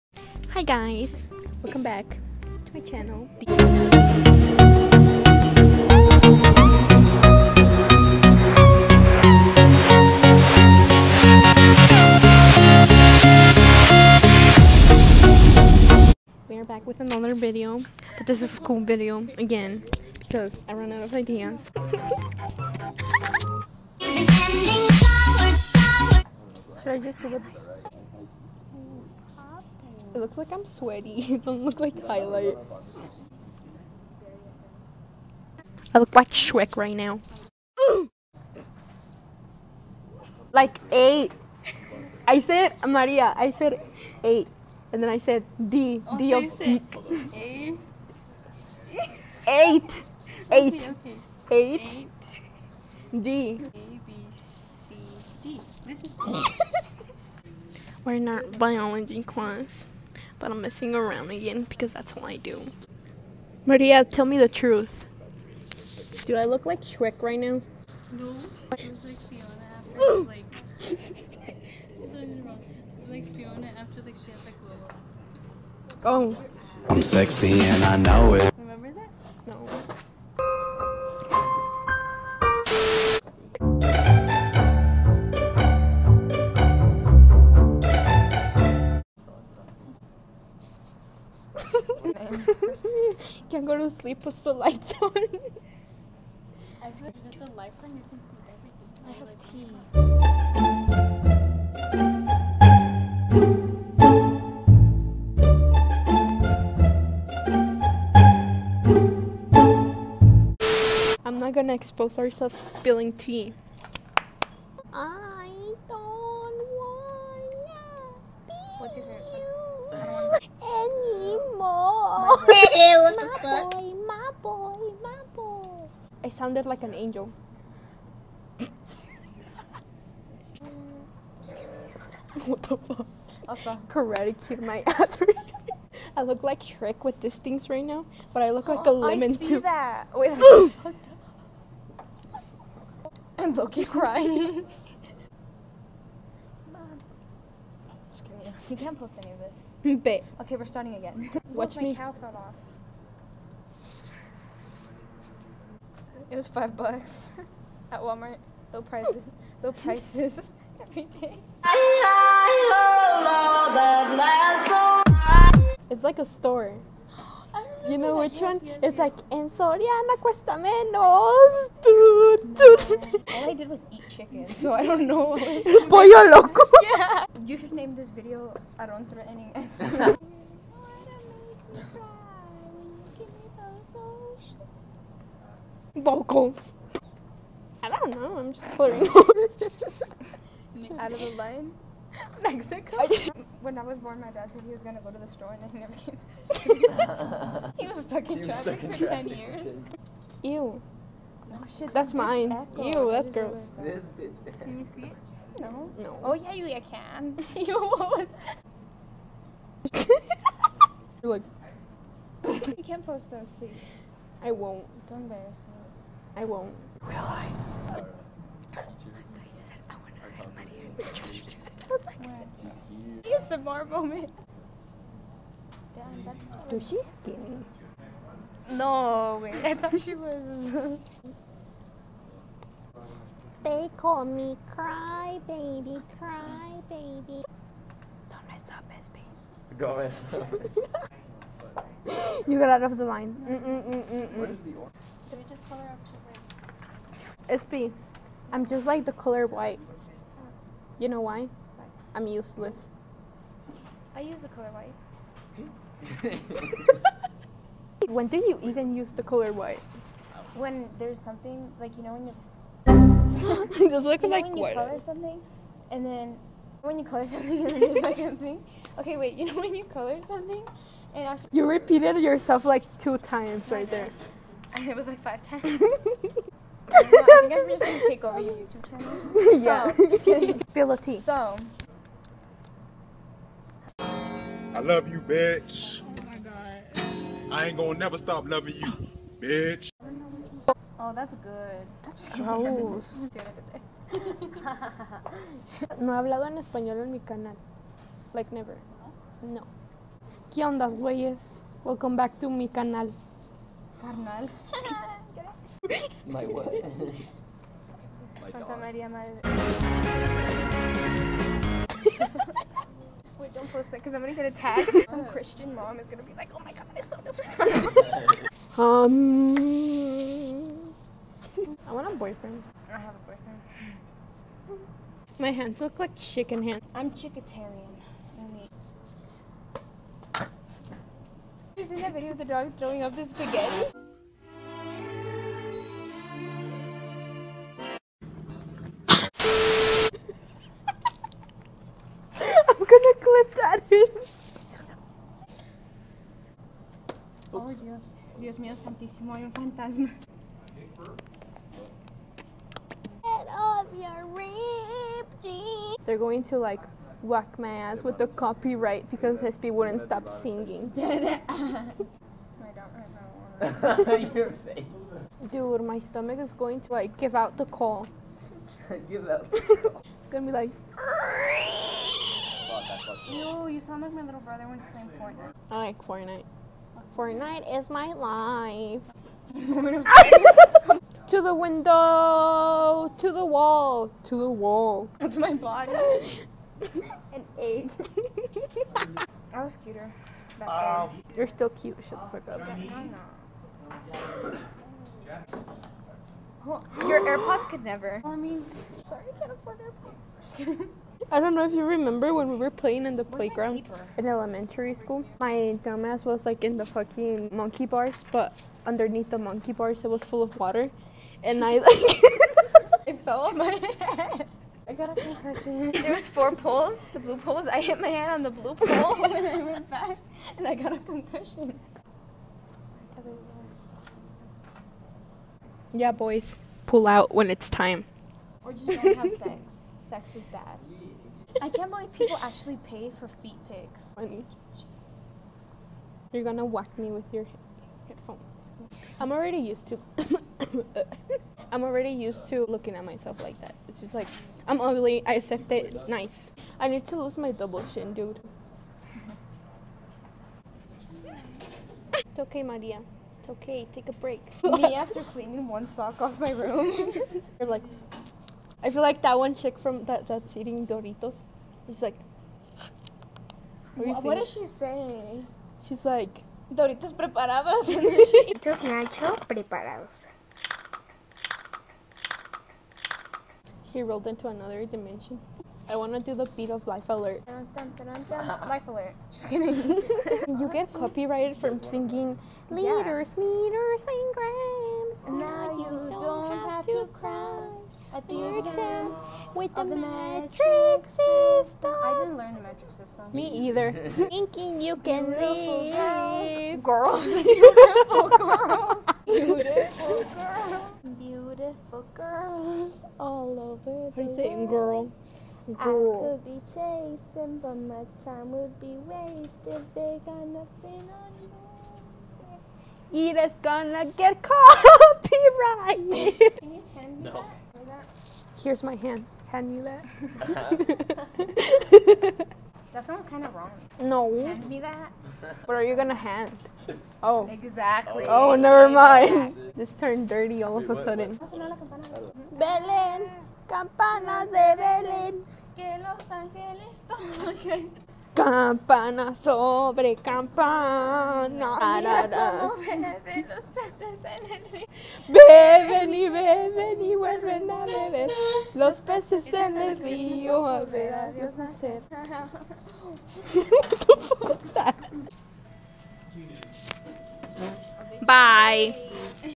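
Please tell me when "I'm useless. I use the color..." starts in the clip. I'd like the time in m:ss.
4:12.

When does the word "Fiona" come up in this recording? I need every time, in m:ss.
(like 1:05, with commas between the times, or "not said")
1:09, 1:13.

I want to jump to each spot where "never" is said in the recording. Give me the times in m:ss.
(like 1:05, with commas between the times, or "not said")
3:15, 4:47, 4:58, 6:37, 8:48.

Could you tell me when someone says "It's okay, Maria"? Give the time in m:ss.
7:32.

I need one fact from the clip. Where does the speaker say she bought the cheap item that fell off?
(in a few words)
Walmart.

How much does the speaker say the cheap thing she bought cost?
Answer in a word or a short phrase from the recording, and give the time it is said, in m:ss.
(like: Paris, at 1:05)
5 bucks, at 2:36.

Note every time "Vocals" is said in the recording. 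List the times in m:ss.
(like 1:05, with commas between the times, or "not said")
3:05.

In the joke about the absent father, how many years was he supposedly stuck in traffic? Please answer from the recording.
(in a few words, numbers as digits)
10.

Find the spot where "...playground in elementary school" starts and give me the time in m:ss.
6:43.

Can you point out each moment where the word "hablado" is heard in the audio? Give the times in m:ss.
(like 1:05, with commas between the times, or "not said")
4:56.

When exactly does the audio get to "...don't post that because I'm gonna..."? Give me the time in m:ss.
5:13.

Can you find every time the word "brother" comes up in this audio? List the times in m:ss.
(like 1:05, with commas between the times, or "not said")
6:14.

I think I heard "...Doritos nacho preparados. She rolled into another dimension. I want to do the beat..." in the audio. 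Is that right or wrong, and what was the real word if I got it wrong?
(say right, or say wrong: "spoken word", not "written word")
right.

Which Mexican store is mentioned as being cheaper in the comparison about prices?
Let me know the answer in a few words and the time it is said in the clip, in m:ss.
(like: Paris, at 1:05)
Soriana, at 2:49.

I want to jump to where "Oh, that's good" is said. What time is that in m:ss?
4:50.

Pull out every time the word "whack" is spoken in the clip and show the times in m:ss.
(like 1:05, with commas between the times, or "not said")
5:57, 7:16.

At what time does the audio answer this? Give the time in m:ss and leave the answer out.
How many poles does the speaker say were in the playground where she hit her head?
6:56.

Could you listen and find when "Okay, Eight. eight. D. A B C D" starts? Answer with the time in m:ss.
0:51.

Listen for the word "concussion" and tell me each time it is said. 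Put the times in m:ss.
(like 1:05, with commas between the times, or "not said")
6:55, 7:00.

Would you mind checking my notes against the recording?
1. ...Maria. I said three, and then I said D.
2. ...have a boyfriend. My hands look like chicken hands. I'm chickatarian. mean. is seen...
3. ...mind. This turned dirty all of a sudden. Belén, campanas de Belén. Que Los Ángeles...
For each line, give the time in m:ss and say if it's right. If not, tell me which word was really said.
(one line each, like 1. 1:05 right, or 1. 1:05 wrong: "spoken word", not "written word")
1. 0:42 wrong: "eight", not "three"
2. 5:22 right
3. 8:48 right.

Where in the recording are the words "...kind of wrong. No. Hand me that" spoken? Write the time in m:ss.
8:43.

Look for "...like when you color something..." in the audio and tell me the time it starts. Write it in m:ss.
4:24.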